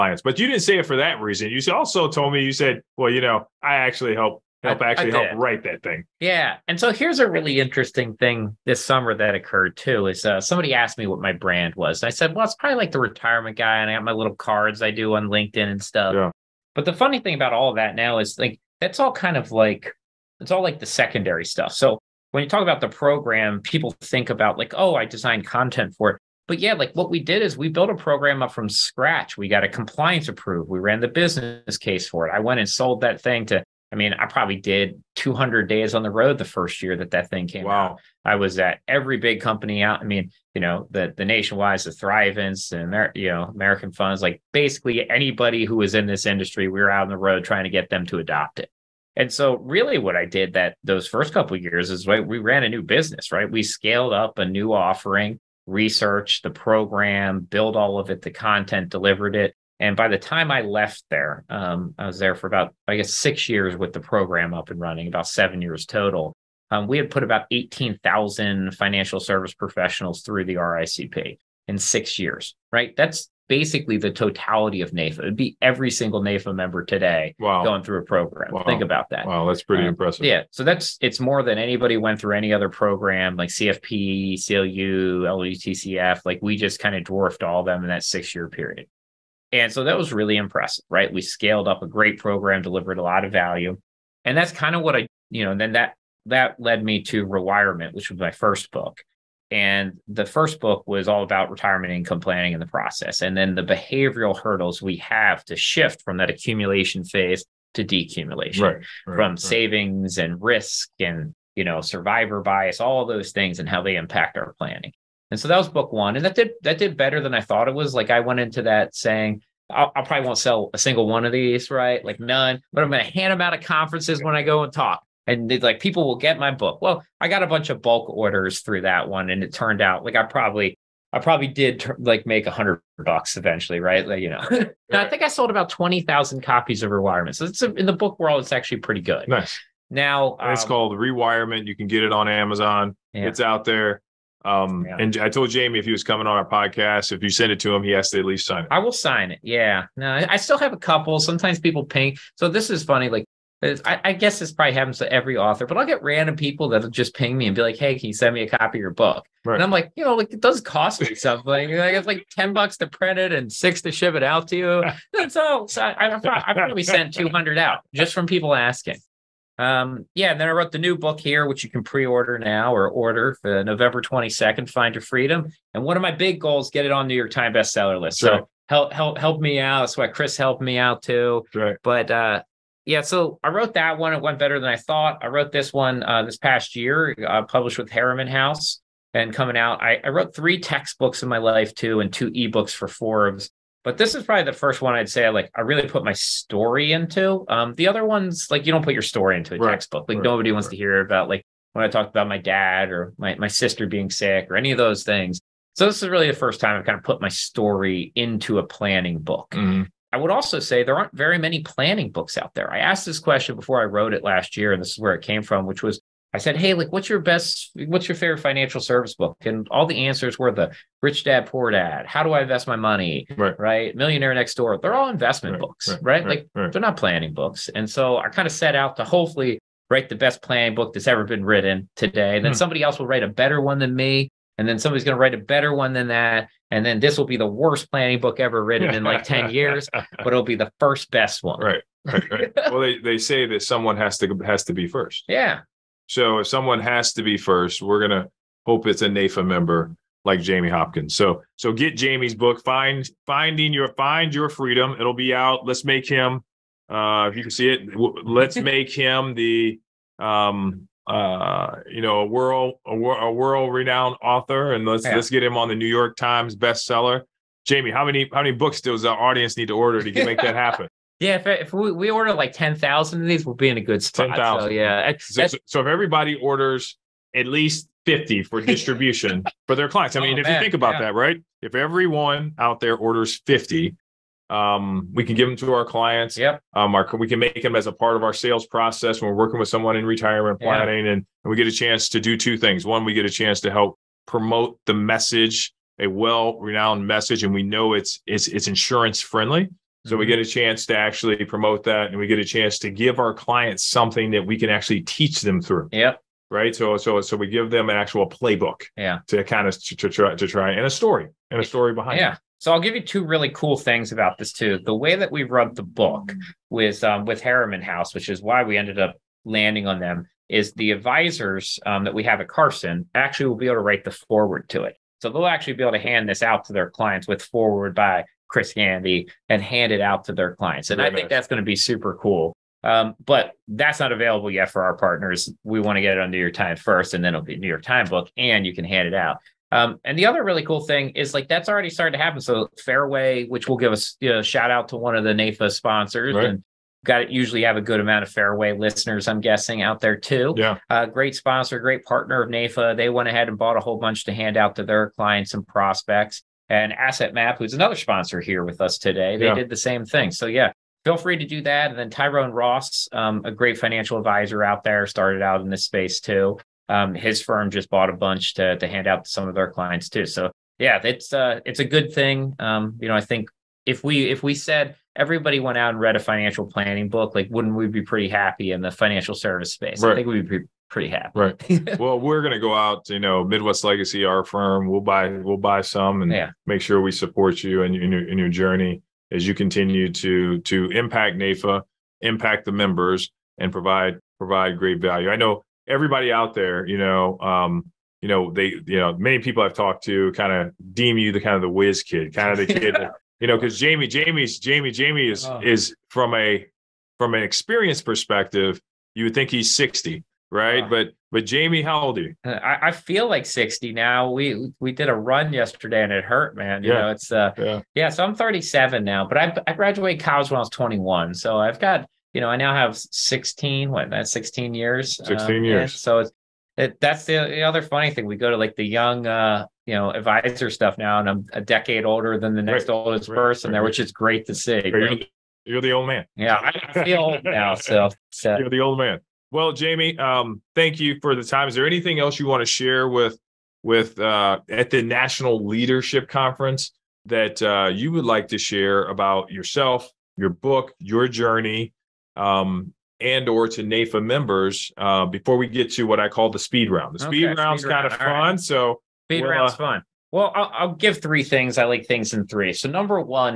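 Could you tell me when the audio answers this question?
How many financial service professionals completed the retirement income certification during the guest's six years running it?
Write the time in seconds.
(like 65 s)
67 s.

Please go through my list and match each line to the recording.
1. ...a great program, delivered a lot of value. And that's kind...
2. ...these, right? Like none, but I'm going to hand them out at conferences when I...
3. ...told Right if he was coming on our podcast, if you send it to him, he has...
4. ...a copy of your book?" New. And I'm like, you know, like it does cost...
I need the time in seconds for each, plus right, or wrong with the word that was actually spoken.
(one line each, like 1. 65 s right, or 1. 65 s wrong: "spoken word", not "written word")
1. 91 s right
2. 121 s right
3. 145 s wrong: "Jamie", not "Right"
4. 158 s wrong: "Right", not "New".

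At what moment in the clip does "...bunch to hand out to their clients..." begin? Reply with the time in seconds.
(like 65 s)
353 s.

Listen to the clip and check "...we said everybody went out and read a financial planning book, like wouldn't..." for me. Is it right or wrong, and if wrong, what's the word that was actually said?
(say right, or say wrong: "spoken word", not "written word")
right.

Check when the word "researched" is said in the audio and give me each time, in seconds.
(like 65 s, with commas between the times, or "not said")
55 s.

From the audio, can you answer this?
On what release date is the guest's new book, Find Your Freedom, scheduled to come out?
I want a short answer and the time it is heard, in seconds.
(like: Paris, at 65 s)
November 22nd, at 173 s.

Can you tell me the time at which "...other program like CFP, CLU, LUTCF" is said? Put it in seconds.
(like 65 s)
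82 s.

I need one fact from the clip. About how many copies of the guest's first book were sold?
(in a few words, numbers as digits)
20,000.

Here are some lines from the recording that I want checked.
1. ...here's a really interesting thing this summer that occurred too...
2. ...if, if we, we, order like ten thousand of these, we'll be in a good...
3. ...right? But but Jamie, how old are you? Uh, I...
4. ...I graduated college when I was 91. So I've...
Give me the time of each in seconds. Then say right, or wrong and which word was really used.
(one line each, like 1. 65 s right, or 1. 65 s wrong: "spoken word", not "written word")
1. 6 s right
2. 271 s right
3. 410 s right
4. 419 s wrong: "21", not "91".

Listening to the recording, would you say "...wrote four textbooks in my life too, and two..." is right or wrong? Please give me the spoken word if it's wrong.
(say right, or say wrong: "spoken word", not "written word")
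wrong: "three", not "four".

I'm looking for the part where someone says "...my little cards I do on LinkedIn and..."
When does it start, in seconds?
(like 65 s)
14 s.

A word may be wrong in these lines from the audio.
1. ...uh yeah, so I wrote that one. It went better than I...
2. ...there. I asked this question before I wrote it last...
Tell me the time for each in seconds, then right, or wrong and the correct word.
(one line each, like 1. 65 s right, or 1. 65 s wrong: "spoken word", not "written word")
1. 182 s right
2. 212 s right.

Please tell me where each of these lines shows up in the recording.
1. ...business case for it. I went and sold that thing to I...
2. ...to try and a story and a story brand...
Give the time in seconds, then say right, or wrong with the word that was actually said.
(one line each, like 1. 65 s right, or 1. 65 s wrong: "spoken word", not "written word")
1. 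31 s right
2. 310 s wrong: "behind", not "brand".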